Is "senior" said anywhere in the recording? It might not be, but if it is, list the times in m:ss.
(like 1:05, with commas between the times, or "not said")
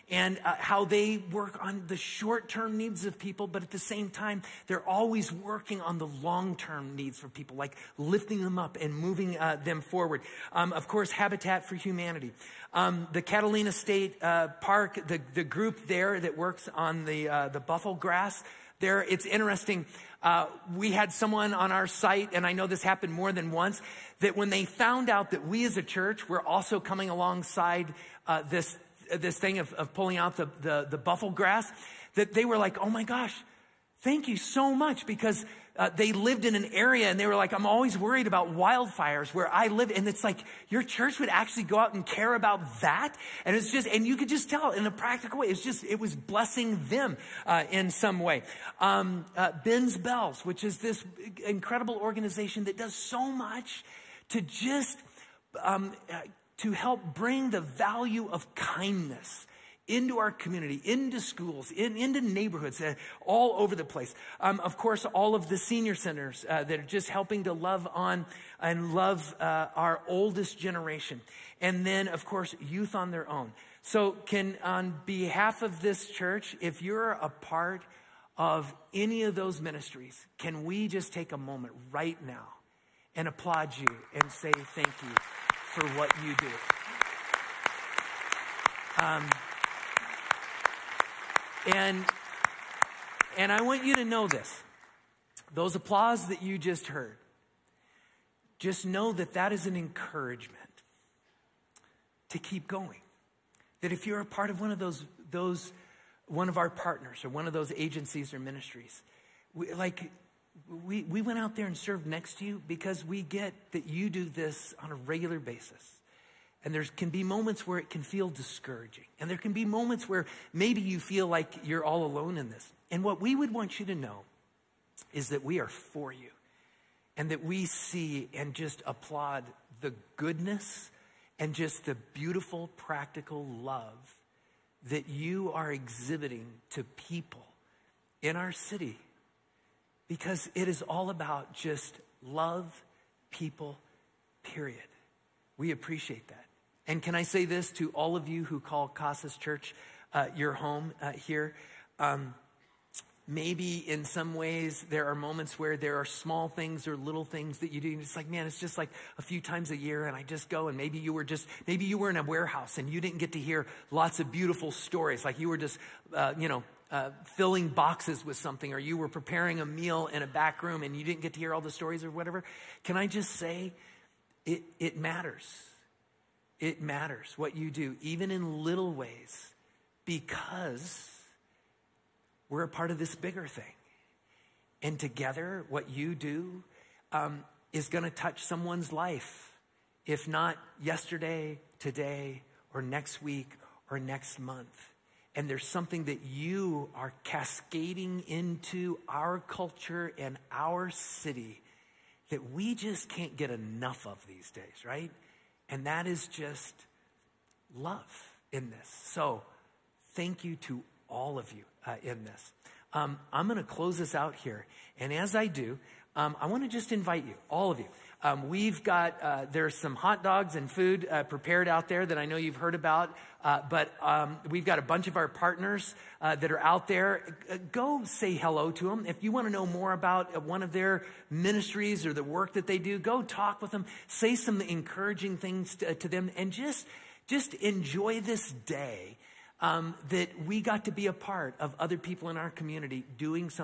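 1:05.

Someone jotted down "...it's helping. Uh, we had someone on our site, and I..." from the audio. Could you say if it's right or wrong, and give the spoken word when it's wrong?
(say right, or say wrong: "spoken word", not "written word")
wrong: "interesting", not "helping".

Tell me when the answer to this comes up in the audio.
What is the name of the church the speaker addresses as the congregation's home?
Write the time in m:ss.
2:28.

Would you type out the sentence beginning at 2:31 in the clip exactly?
Um, maybe in some ways there are moments where there are small things or little things that you do.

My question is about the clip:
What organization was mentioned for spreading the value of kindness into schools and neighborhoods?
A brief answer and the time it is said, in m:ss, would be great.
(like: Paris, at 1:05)
Ben's Bells, at 0:49.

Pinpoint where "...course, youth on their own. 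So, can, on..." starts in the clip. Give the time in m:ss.
1:12.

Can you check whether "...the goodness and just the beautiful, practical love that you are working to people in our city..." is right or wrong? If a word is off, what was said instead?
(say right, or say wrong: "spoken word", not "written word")
wrong: "exhibiting", not "working".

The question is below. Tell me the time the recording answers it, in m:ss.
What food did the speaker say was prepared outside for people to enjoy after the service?
3:39.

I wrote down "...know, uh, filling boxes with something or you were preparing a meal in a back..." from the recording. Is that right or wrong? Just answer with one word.
right.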